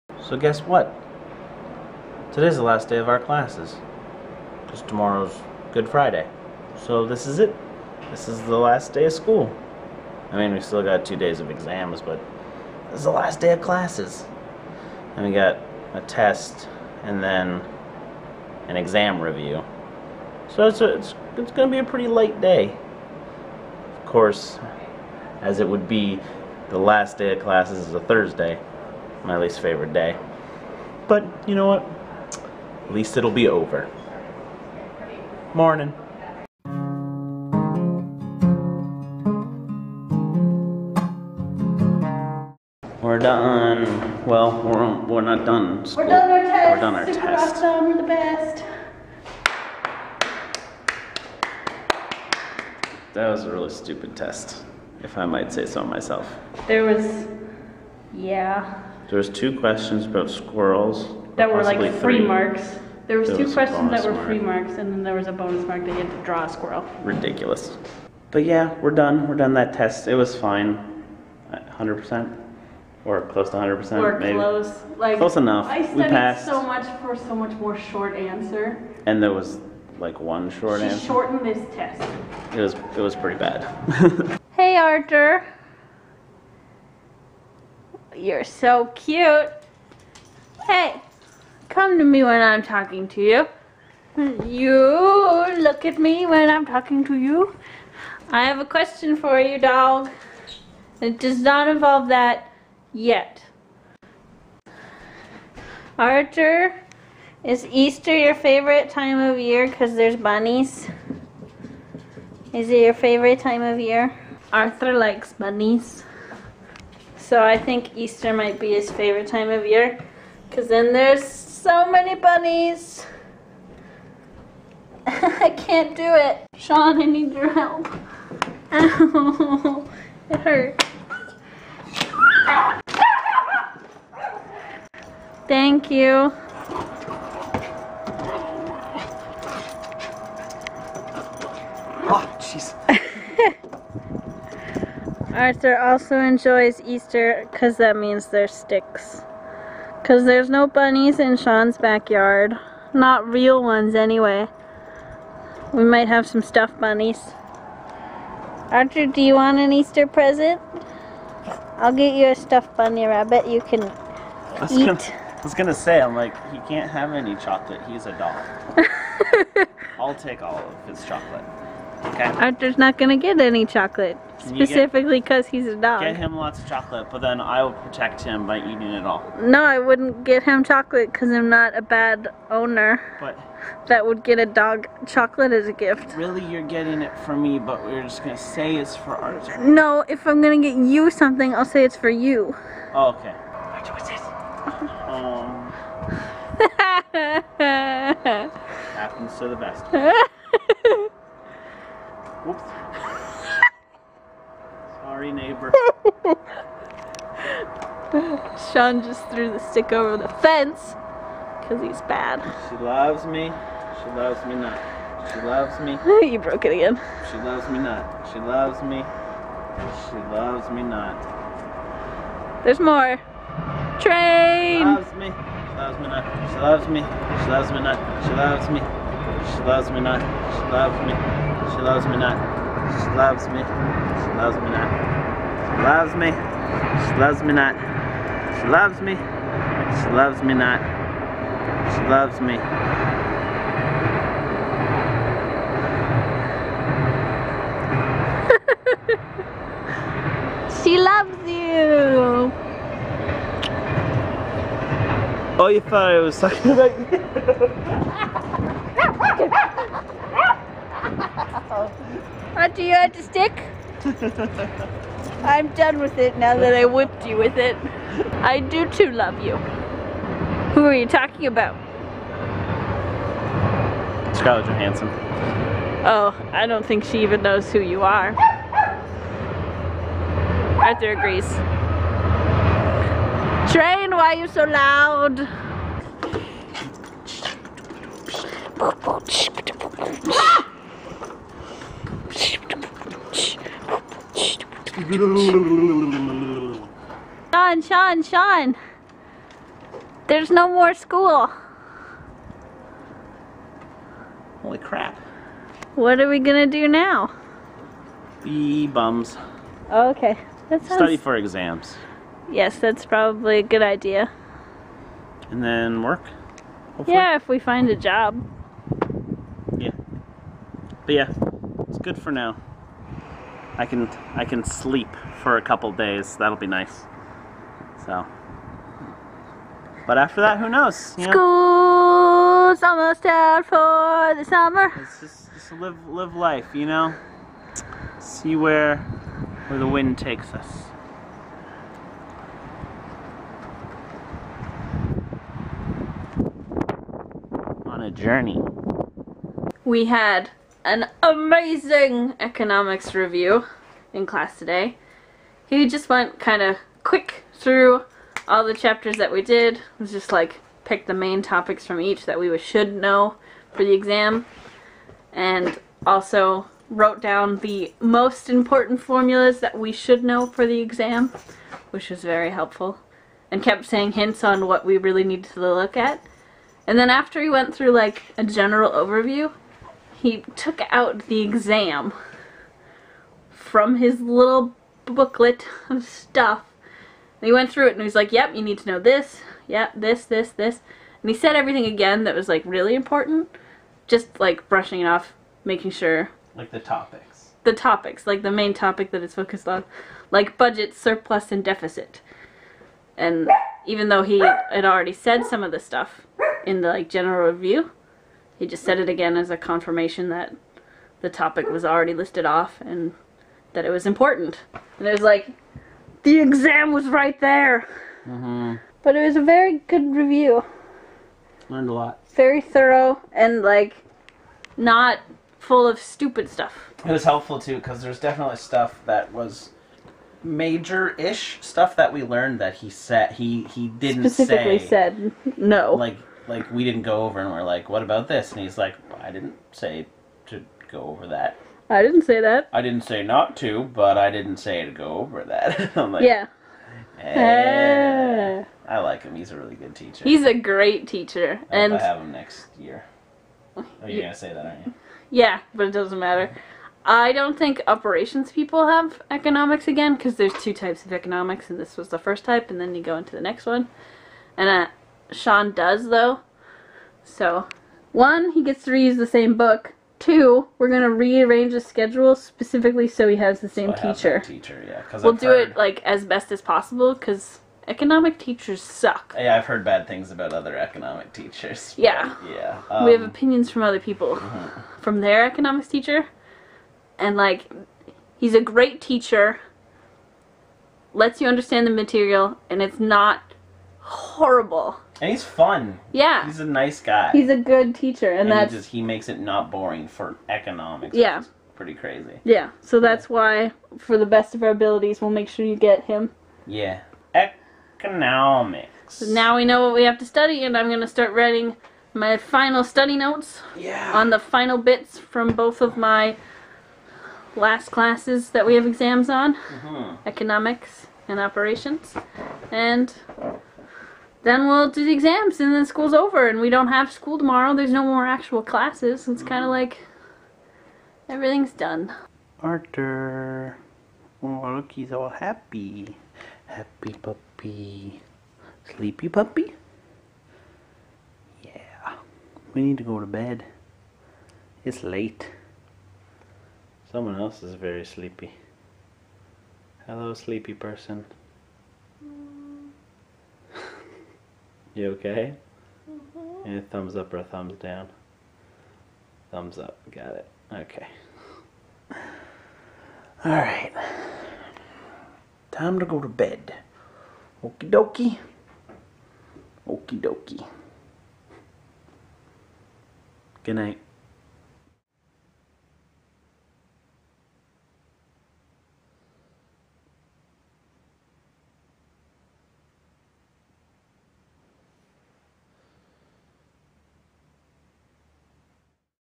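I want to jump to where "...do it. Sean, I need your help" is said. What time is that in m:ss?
2:05.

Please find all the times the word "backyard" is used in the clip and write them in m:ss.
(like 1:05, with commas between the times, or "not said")
2:31.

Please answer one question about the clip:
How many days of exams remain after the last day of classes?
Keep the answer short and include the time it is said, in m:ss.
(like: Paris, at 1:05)
2, at 0:11.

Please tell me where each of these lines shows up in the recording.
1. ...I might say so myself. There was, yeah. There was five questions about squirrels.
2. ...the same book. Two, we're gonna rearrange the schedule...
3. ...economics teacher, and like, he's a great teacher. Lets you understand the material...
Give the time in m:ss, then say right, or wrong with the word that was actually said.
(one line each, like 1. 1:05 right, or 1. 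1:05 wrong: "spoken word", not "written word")
1. 0:55 wrong: "two", not "five"
2. 7:49 right
3. 8:05 right.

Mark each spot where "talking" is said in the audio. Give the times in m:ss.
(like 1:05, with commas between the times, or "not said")
1:32, 1:36, 4:16, 4:31.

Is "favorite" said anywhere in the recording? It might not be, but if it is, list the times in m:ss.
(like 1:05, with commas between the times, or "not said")
0:29, 1:48, 1:52, 1:58.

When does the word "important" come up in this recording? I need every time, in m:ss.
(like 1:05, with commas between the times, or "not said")
6:08, 6:32, 6:54.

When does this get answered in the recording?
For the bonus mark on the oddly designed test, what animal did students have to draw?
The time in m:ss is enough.
1:06.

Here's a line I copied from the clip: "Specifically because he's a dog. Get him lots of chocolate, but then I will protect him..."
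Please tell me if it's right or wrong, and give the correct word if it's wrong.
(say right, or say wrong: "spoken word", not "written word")
right.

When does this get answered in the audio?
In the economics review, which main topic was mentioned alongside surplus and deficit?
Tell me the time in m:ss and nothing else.
6:40.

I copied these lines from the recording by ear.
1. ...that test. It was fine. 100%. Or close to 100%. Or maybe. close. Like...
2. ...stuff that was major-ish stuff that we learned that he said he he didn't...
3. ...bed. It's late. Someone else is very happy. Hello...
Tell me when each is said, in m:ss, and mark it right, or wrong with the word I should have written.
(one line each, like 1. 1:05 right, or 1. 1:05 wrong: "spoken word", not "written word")
1. 1:09 right
2. 7:08 right
3. 9:03 wrong: "sleepy", not "happy".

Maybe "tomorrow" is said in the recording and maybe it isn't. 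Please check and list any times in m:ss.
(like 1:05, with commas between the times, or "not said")
0:04, 8:47.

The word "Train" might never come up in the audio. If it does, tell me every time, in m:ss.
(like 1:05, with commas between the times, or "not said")
3:43, 4:43.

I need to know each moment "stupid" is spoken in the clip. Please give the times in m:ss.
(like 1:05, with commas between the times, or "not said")
0:53, 7:05.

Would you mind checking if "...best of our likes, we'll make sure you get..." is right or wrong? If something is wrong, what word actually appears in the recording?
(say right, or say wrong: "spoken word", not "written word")
wrong: "abilities", not "likes".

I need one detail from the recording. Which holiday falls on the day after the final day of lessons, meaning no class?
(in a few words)
Good Friday.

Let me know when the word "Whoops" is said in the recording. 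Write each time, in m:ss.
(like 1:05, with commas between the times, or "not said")
3:22.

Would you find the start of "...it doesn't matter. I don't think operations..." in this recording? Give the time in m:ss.
7:35.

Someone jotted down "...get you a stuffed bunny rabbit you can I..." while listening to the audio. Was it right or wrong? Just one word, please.
right.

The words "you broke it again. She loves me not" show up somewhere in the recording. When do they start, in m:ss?
3:36.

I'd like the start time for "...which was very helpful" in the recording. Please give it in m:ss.
6:11.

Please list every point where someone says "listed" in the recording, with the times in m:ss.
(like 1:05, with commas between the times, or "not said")
6:52.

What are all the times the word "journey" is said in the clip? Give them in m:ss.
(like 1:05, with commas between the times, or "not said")
5:48.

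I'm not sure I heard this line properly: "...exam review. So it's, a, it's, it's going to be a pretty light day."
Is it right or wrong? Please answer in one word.
right.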